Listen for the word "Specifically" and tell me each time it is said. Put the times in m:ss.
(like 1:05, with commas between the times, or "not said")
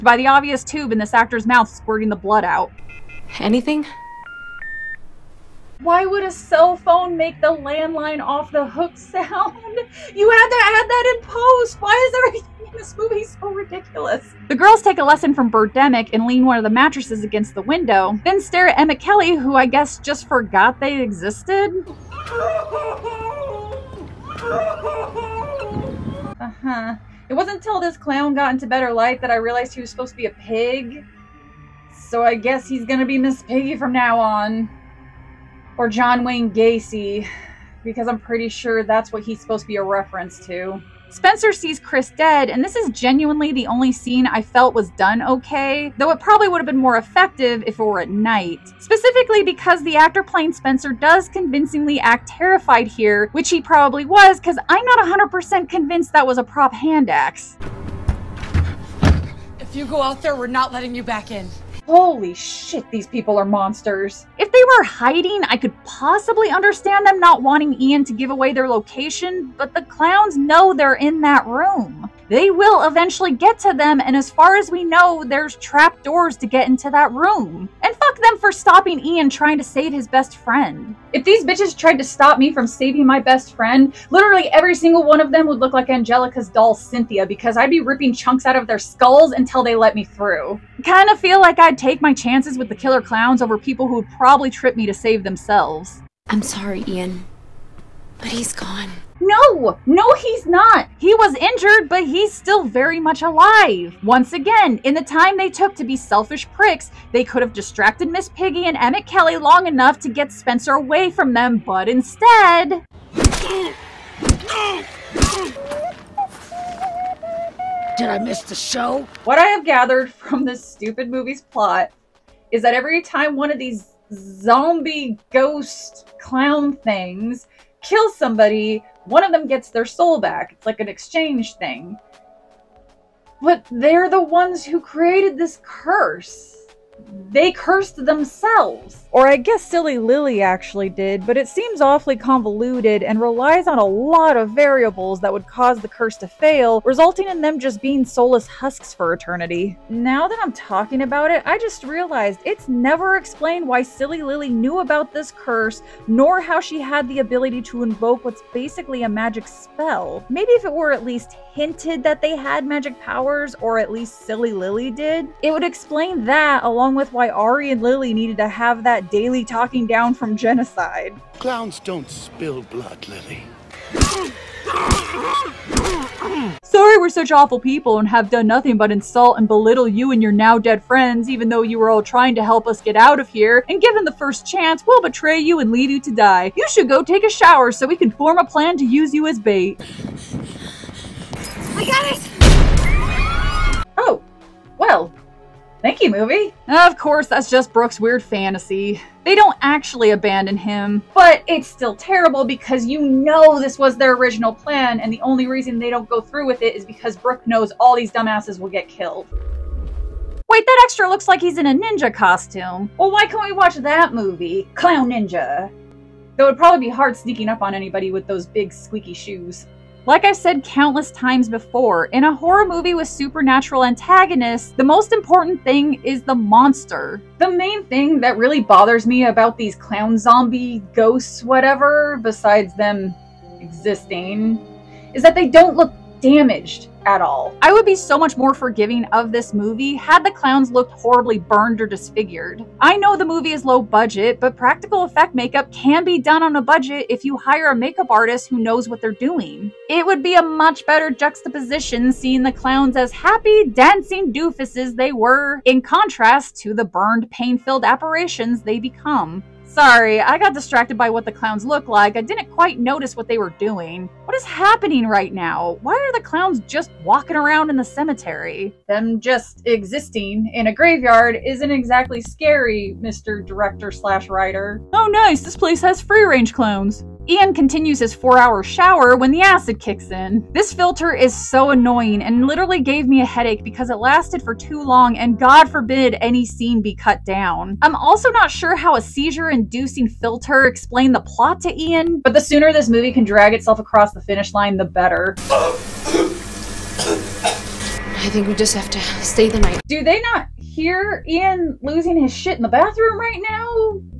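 0:48.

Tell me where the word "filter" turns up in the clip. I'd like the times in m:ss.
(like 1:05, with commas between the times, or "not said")
4:40, 4:50.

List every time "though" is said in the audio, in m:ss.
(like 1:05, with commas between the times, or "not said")
0:45, 3:01, 3:36.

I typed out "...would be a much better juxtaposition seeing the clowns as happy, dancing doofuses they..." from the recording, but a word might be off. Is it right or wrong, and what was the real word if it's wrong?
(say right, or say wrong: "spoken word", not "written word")
right.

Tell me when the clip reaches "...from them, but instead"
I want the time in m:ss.
1:51.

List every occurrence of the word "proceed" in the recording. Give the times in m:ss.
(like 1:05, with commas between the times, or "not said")
not said.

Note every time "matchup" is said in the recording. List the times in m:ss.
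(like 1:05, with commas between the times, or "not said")
not said.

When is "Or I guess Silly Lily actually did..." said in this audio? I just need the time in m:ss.
2:19.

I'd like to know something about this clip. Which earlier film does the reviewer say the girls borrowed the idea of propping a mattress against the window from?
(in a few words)
Birdemic.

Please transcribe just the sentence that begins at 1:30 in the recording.
Kinda feel like I'd take my chances with the killer clowns over people who would probably trip me to save themselves.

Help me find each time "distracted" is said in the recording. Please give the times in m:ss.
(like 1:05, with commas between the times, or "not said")
1:47, 4:20.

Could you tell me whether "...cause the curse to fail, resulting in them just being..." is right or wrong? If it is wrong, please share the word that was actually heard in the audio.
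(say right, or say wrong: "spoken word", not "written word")
right.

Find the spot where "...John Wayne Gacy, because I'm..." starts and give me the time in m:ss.
0:35.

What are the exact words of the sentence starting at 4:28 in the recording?
Them just existing in a graveyard isn't exactly scary, Mr.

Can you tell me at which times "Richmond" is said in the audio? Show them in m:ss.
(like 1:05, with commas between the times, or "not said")
not said.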